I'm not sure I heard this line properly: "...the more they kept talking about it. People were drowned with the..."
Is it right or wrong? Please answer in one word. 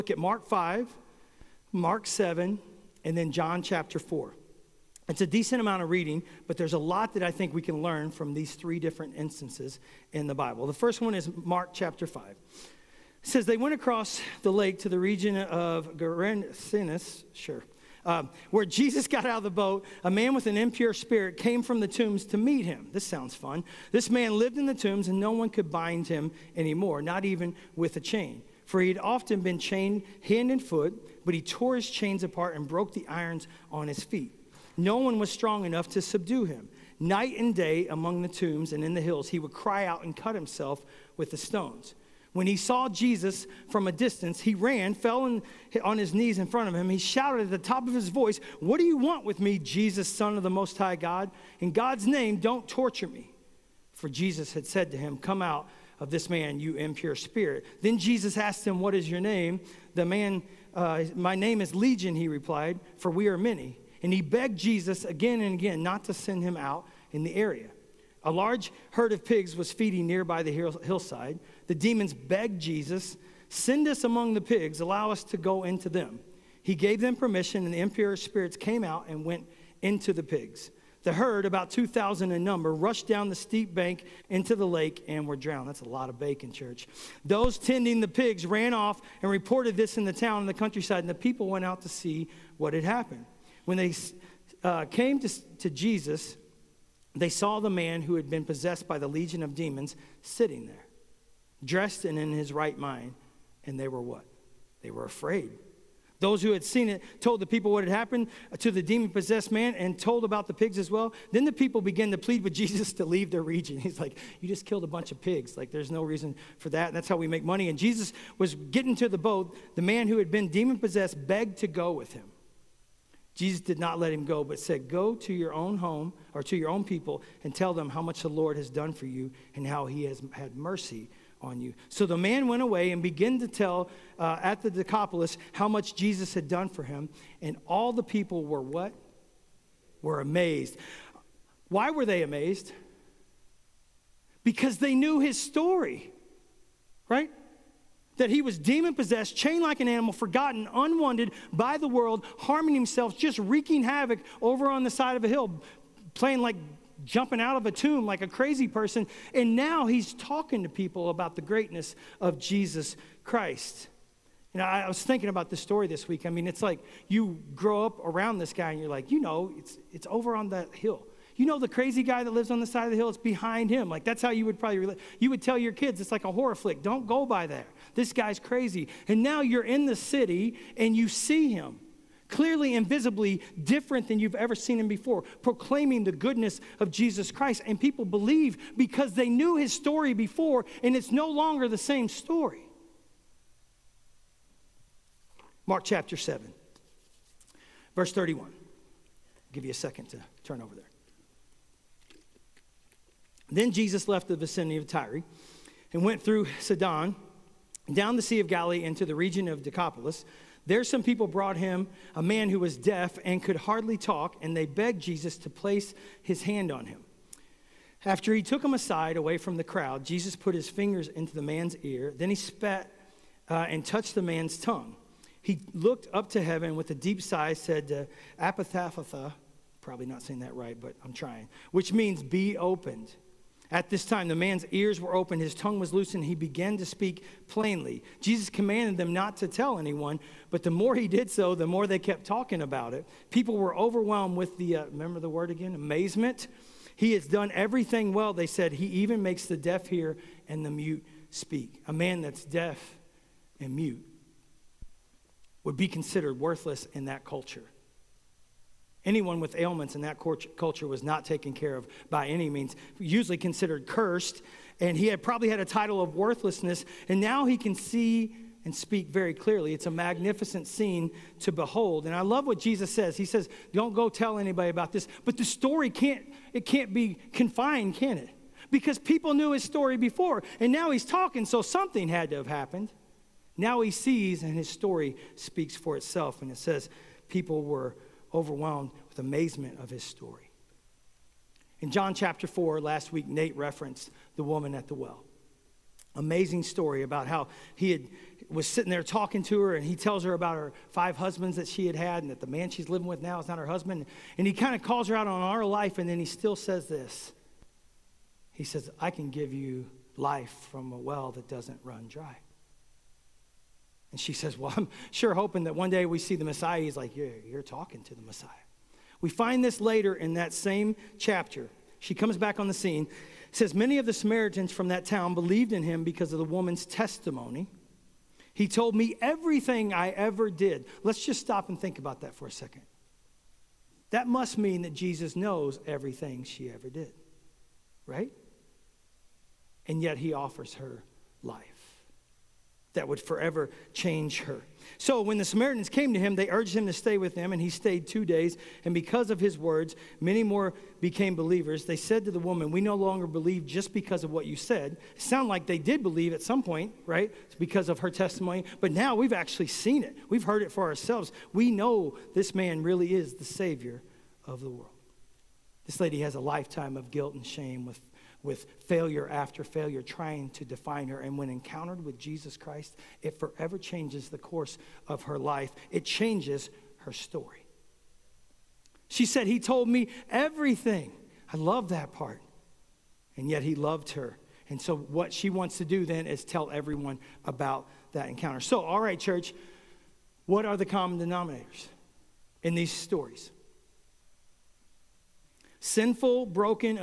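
wrong.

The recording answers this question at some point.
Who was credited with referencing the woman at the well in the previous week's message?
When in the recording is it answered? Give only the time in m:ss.
4:53.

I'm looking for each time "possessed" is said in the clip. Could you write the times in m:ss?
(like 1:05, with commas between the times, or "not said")
1:38, 1:49, 2:00, 2:28.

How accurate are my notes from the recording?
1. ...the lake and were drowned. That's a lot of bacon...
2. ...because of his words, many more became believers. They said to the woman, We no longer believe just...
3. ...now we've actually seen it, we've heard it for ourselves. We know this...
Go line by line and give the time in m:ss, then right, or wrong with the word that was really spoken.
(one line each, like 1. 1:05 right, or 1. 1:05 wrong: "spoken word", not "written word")
1. 1:24 right
2. 5:48 right
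3. 5:58 right.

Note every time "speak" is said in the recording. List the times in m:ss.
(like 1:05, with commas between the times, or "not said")
3:56, 4:11, 4:28, 4:45.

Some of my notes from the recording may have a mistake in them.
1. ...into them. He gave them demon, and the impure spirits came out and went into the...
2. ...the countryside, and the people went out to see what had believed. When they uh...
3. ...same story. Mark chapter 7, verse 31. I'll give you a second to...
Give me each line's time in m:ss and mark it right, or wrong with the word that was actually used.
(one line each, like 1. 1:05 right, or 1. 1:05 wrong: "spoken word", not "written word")
1. 1:15 wrong: "permission", not "demon"
2. 1:30 wrong: "happened", not "believed"
3. 3:11 right.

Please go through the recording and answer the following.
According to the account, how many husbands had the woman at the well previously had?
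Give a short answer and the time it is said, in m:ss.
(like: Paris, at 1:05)
5, at 5:00.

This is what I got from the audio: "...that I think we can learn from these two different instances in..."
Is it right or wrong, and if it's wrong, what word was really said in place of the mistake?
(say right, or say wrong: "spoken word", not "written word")
wrong: "three", not "two".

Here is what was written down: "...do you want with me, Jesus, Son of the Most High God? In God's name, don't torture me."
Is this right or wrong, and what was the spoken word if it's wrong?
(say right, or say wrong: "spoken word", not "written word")
right.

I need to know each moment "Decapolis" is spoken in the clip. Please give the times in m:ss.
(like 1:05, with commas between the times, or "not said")
2:14, 3:29.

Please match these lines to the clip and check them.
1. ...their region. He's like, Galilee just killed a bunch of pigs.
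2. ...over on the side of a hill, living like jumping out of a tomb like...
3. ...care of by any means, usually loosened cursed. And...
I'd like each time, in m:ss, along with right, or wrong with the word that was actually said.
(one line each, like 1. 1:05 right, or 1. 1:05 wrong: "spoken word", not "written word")
1. 1:53 wrong: "You", not "Galilee"
2. 2:34 wrong: "playing", not "living"
3. 4:21 wrong: "considered", not "loosened".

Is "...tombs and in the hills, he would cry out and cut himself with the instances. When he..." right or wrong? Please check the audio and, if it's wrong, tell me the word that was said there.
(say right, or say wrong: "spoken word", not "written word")
wrong: "stones", not "instances".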